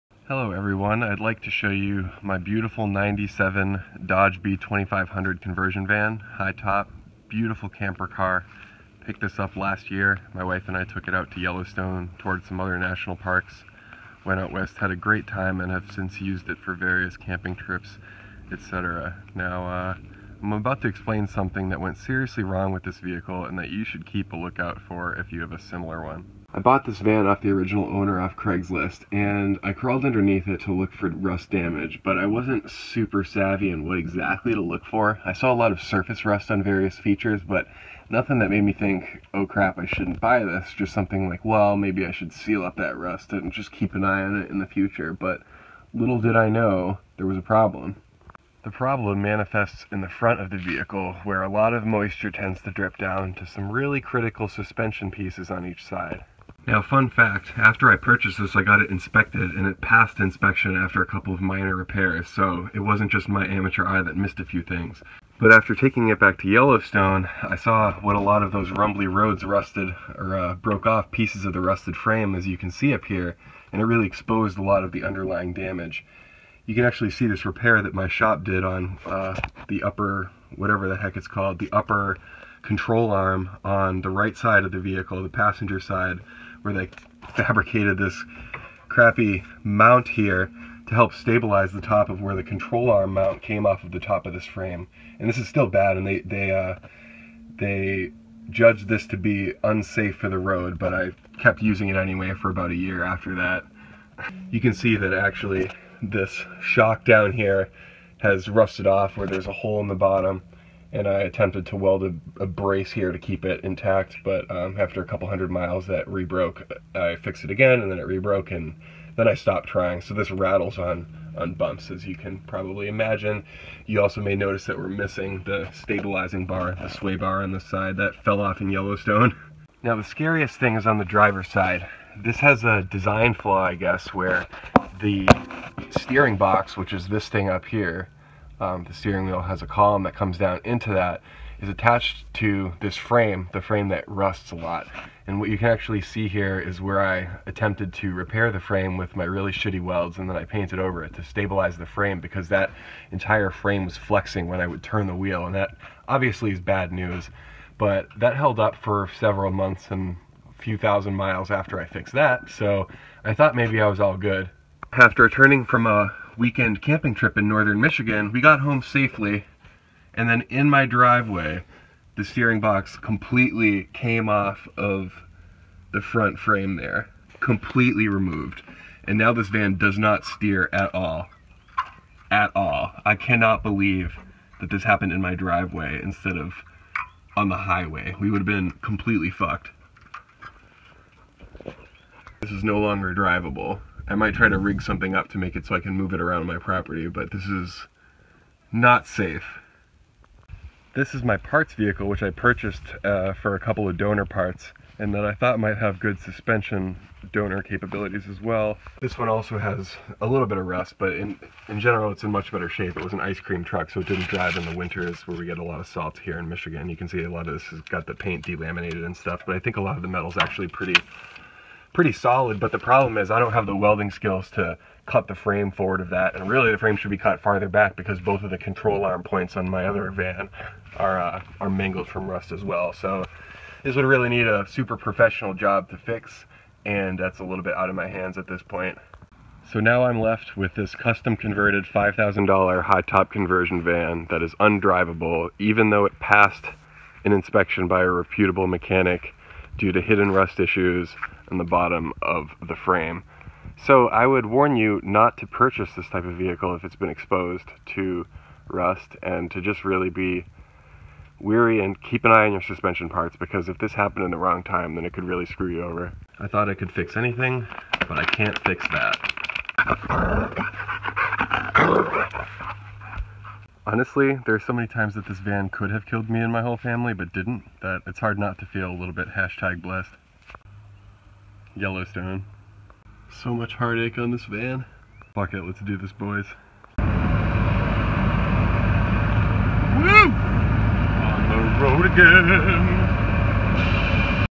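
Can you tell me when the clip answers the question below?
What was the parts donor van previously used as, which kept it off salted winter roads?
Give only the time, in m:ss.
3:33.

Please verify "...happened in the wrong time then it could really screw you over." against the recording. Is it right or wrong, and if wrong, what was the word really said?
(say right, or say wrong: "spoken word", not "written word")
right.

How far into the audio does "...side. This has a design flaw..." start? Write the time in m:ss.
2:11.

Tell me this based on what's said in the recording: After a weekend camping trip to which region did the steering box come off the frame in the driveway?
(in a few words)
Northern Michigan.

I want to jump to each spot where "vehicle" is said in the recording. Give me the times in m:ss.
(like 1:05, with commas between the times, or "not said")
0:23, 0:50, 1:24, 3:21, 4:16.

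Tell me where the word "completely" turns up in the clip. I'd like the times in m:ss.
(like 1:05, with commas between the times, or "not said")
2:52, 2:57, 3:08.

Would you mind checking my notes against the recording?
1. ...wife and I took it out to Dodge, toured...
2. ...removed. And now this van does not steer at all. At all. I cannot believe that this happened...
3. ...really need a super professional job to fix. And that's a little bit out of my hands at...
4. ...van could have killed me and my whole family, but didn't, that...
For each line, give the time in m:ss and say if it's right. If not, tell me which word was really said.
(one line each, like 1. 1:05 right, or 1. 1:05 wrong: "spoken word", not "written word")
1. 0:10 wrong: "Yellowstone", not "Dodge"
2. 2:58 right
3. 3:54 right
4. 4:35 right.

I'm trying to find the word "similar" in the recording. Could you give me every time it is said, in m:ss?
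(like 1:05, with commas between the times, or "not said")
0:25.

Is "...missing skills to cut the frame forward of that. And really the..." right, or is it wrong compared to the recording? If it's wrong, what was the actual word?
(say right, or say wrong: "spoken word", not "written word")
wrong: "welding", not "missing".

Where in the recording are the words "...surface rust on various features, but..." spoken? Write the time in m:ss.
0:35.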